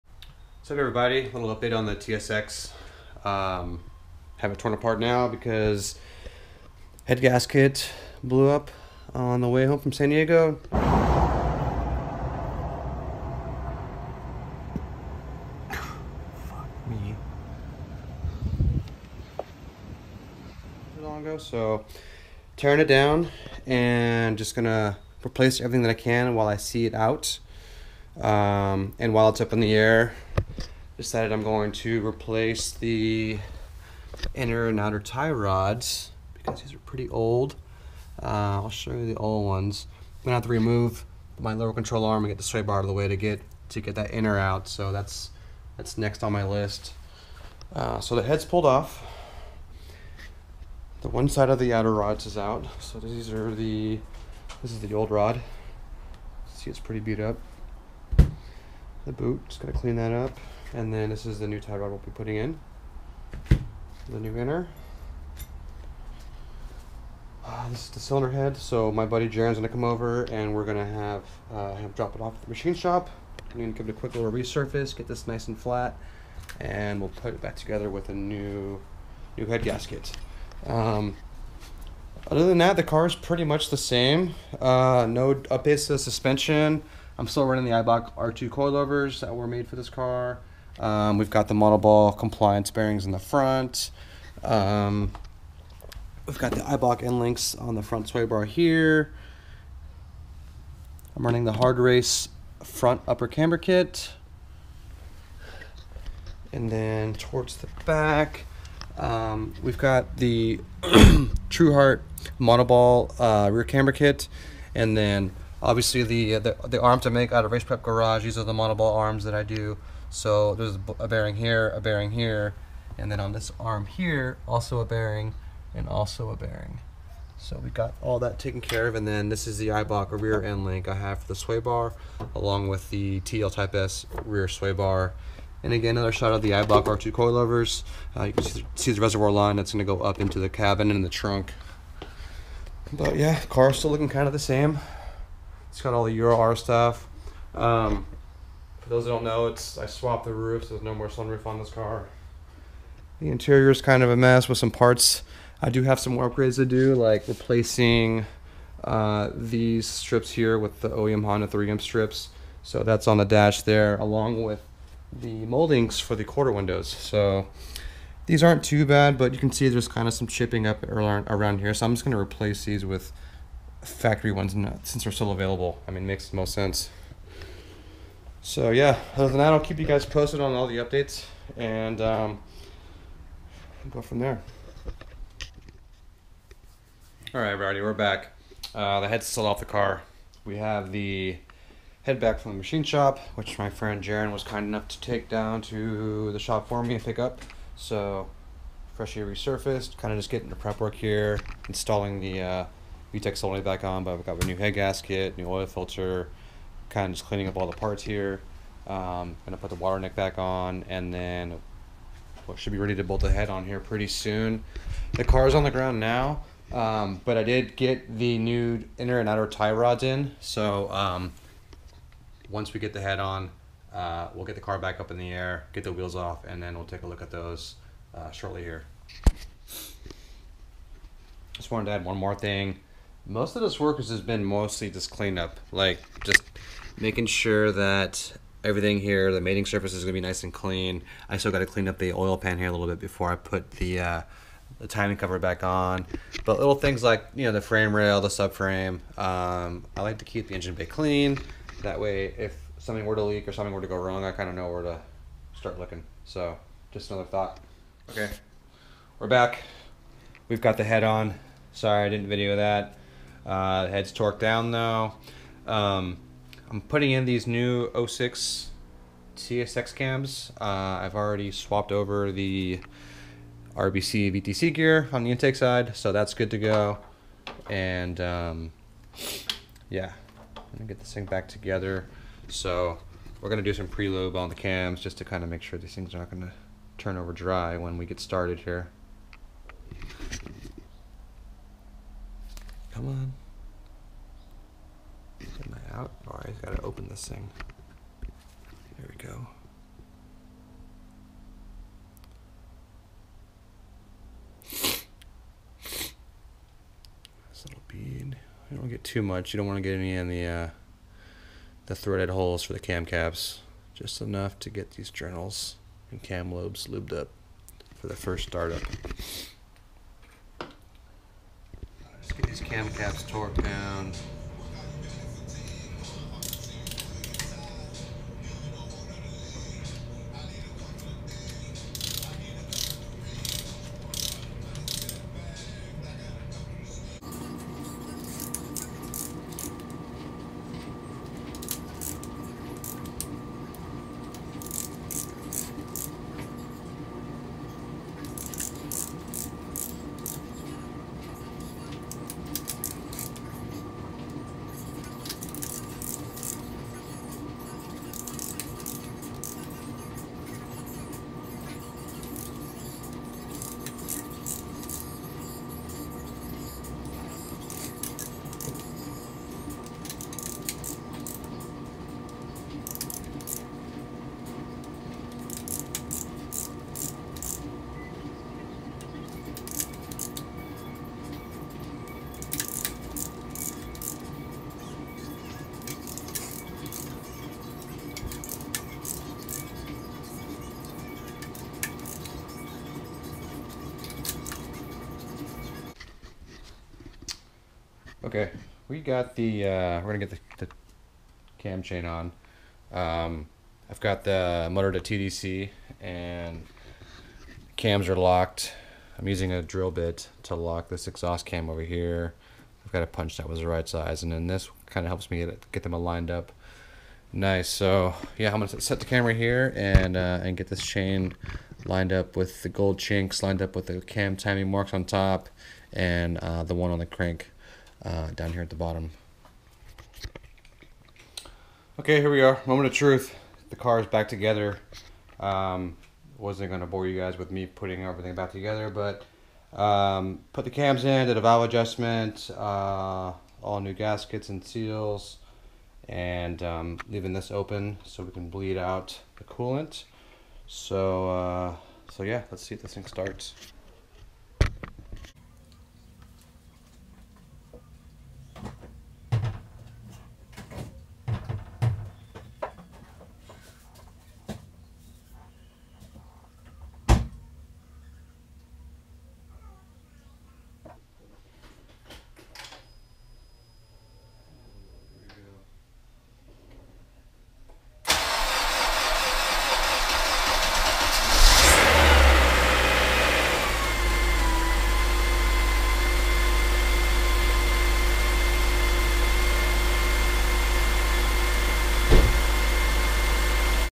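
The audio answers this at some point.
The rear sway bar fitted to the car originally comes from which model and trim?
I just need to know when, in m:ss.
2:13.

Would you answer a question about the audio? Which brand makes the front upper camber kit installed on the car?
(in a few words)
Hard Race.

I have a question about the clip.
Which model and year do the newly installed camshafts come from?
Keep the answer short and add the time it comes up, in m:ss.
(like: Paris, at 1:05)
06 CSX, at 4:28.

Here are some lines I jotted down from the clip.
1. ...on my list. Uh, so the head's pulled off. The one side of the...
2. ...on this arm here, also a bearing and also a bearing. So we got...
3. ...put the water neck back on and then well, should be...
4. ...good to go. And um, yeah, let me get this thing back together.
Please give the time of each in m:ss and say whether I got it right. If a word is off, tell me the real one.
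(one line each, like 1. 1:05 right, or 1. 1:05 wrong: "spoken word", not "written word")
1. 0:46 right
2. 2:03 right
3. 3:29 right
4. 4:36 right.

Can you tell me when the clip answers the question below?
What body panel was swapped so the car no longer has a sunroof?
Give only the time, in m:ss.
2:30.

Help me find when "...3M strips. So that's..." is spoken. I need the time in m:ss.
2:41.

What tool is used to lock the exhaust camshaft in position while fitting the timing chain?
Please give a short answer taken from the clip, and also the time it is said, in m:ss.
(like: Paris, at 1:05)
A drill bit, at 6:49.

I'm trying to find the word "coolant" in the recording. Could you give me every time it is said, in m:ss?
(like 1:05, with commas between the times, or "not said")
7:29.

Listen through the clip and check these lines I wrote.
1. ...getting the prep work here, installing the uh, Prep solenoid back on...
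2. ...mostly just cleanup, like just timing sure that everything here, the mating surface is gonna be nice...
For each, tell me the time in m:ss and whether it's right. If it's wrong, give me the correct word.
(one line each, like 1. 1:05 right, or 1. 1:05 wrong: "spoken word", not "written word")
1. 3:20 wrong: "VTEC", not "Prep"
2. 3:54 wrong: "making", not "timing".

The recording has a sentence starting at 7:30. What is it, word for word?
So, uh, so yeah, let's see if this thing starts.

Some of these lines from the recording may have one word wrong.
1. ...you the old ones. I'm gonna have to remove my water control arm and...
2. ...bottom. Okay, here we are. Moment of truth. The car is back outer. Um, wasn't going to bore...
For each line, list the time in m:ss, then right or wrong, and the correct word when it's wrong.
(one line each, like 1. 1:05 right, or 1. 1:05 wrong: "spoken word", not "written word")
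1. 0:38 wrong: "lower", not "water"
2. 7:08 wrong: "together", not "outer".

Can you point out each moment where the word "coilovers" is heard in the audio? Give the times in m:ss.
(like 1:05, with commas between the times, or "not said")
1:28, 2:17.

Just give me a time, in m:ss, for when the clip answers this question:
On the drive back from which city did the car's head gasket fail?
0:09.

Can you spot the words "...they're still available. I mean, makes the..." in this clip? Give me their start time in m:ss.
2:55.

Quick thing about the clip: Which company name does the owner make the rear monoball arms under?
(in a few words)
Race Prep Garage.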